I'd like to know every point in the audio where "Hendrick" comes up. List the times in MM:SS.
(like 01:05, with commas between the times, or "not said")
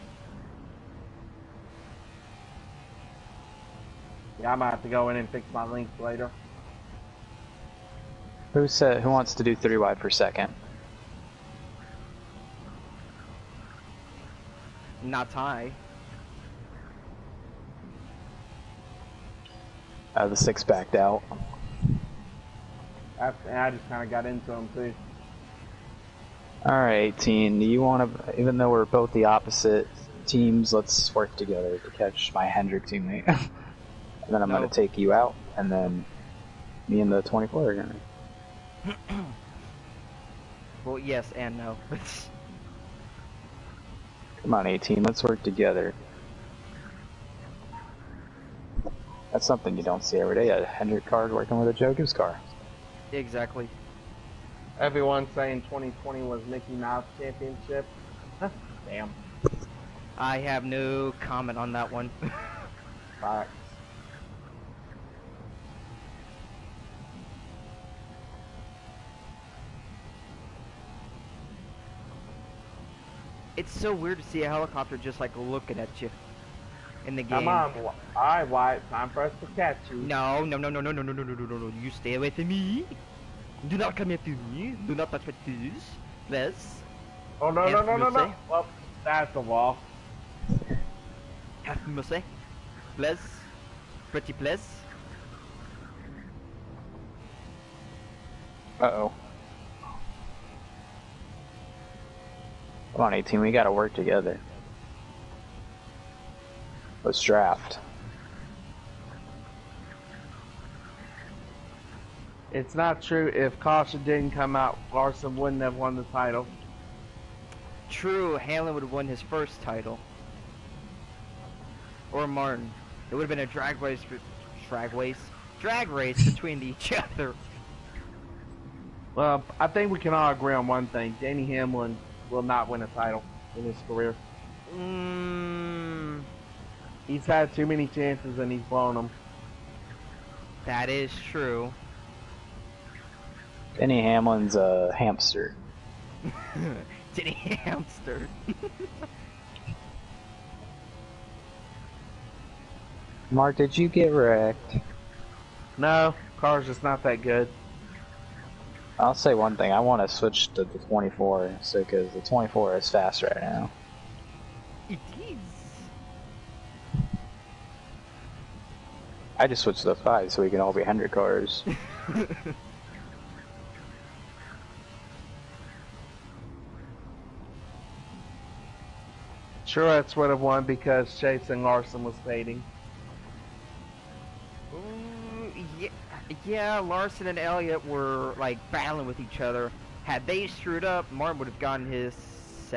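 00:32, 00:50.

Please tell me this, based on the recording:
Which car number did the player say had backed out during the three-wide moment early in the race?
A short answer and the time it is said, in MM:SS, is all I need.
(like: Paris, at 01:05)
6, at 00:20.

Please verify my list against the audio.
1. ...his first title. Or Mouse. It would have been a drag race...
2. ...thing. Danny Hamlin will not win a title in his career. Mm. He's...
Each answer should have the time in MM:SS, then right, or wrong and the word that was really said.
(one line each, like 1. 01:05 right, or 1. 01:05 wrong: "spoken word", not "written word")
1. 01:59 wrong: "Martin", not "Mouse"
2. 02:10 right.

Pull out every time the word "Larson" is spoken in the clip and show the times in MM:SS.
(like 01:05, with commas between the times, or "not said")
01:54, 03:01, 03:06.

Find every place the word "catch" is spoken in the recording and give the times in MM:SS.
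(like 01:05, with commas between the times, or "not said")
00:31, 01:19.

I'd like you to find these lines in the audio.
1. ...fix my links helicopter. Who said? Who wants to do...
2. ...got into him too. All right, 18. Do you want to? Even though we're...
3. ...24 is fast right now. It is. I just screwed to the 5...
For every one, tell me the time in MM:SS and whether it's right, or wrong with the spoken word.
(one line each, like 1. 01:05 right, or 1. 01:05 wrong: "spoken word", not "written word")
1. 00:05 wrong: "later", not "helicopter"
2. 00:24 right
3. 02:42 wrong: "switched", not "screwed".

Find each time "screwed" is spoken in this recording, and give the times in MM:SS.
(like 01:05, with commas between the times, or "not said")
03:10.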